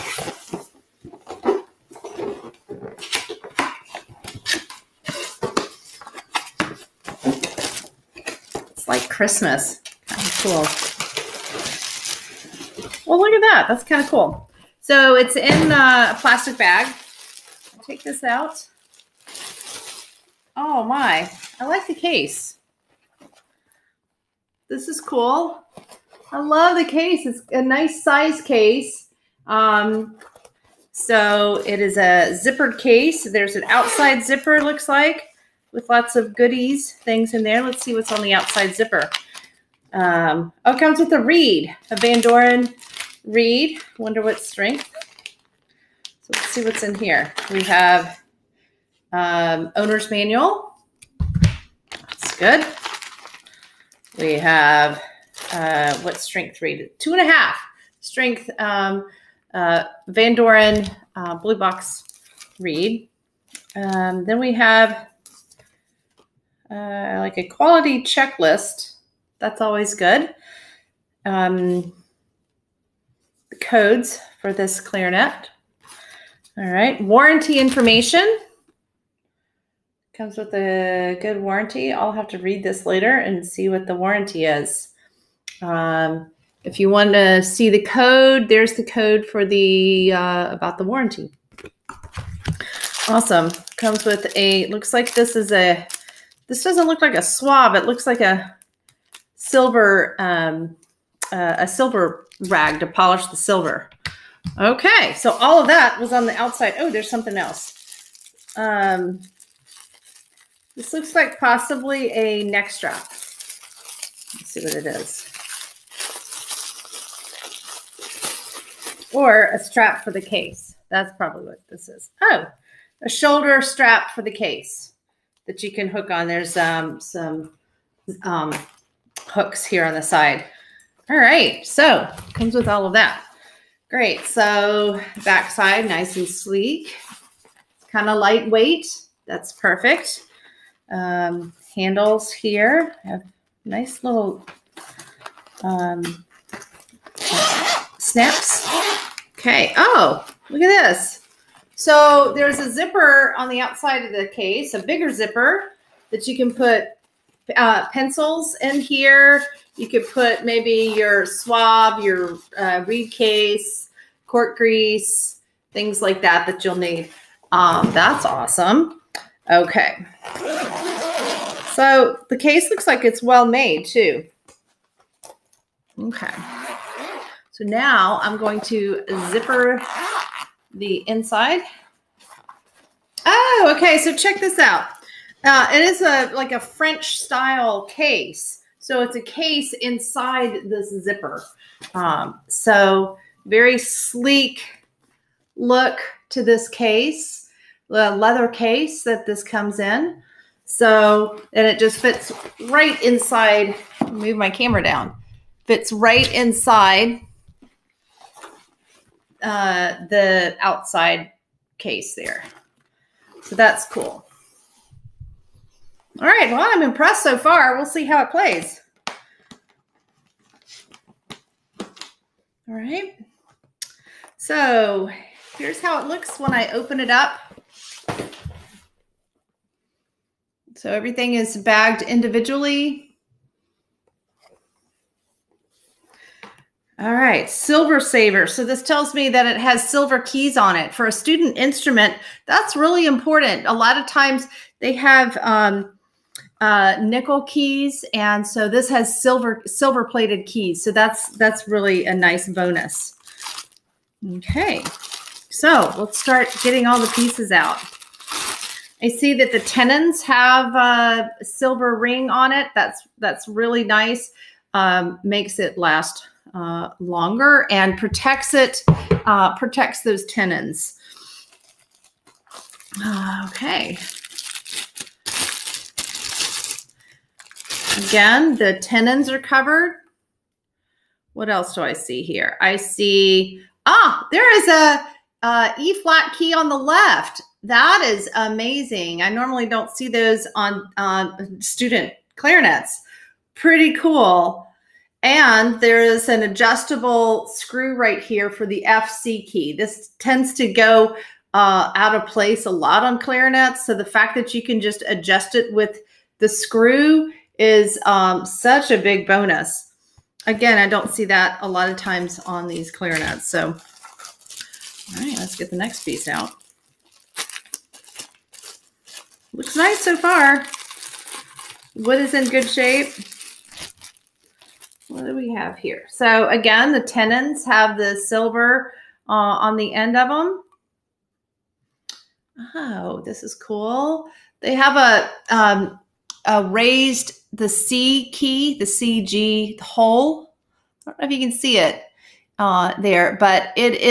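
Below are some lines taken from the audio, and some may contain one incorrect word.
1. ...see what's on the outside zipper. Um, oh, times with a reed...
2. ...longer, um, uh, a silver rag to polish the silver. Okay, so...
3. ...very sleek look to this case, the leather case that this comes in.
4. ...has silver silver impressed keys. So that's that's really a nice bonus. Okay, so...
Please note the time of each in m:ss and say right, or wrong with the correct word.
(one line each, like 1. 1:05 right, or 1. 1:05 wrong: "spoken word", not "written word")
1. 0:37 wrong: "comes", not "times"
2. 1:39 wrong: "silver", not "longer"
3. 3:13 right
4. 4:08 wrong: "plated", not "impressed".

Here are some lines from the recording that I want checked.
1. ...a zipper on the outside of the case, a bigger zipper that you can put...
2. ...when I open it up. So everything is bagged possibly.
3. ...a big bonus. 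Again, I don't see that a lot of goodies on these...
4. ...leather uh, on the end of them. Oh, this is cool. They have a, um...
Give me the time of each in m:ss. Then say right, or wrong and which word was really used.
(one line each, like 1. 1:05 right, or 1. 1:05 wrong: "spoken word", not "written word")
1. 2:32 right
2. 3:46 wrong: "individually", not "possibly"
3. 5:08 wrong: "times", not "goodies"
4. 5:28 wrong: "silver", not "leather".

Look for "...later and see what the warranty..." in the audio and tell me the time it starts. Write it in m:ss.
1:22.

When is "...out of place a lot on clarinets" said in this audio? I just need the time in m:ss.
5:01.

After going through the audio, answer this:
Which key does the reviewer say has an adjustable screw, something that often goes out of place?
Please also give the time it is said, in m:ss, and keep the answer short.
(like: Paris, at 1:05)
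FC key, at 4:58.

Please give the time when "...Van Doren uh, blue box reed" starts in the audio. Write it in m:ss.
1:00.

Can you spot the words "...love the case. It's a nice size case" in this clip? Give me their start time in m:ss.
0:26.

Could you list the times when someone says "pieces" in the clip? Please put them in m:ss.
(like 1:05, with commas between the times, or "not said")
4:17, 5:16.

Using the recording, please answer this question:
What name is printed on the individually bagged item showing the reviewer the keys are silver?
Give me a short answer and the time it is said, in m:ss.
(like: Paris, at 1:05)
Silver Saver, at 3:57.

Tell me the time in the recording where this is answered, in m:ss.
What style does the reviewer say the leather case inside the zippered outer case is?
3:06.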